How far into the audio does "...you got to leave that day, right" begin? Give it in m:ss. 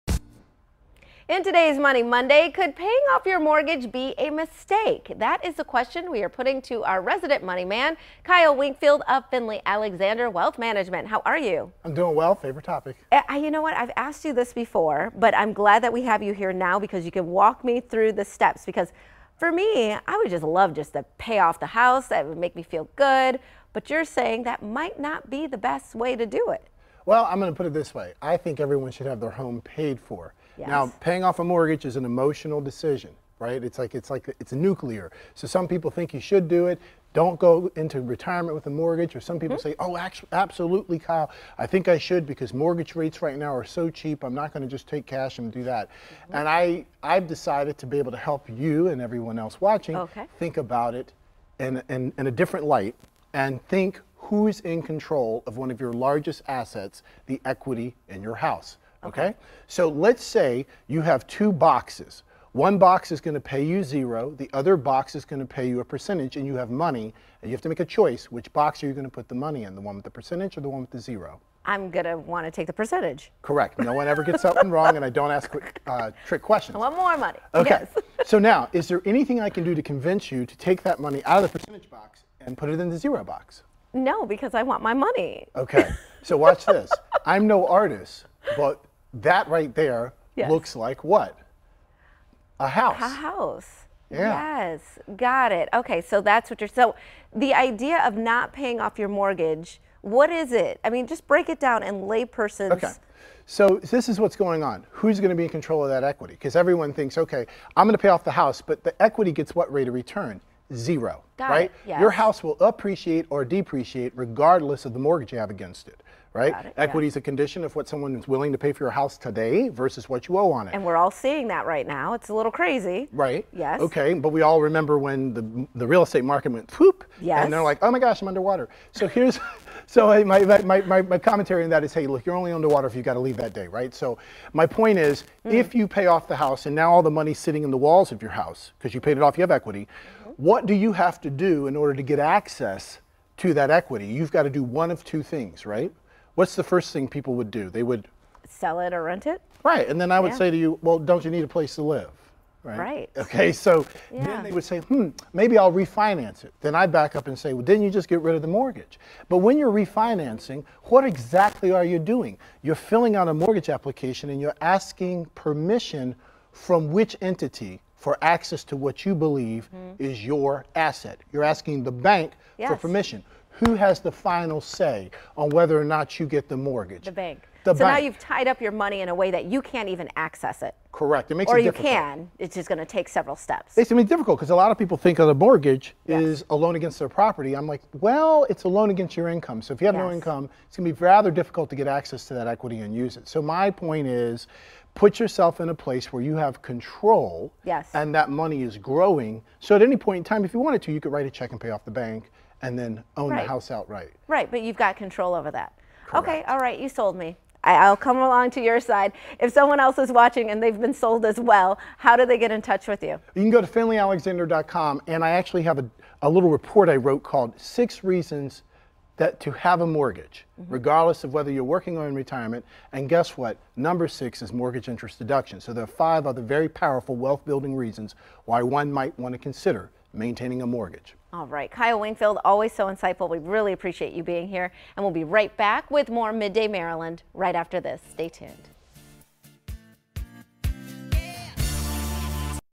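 2:12.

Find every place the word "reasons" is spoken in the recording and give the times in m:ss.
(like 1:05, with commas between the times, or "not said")
3:38, 3:47.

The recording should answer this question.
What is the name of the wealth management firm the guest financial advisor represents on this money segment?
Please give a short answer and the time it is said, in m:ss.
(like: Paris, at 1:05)
Finley Alexander Wealth Management, at 0:09.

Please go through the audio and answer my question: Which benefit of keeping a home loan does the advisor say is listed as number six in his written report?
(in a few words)
mortgage interest deduction.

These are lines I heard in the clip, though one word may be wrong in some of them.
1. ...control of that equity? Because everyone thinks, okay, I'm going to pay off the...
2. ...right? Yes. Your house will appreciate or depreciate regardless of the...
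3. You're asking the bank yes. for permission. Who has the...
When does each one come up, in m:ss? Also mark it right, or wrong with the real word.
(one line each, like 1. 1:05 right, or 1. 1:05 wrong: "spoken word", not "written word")
1. 1:45 right
2. 1:51 right
3. 2:51 right.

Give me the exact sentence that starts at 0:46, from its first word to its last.
And I, I've decided to be able to help you and everyone else watching okay.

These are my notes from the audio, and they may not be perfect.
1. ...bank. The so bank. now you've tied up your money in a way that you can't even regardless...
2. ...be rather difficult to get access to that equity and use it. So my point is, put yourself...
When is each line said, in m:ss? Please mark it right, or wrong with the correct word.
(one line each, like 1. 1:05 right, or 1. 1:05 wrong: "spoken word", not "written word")
1. 2:57 wrong: "access", not "regardless"
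2. 3:10 right.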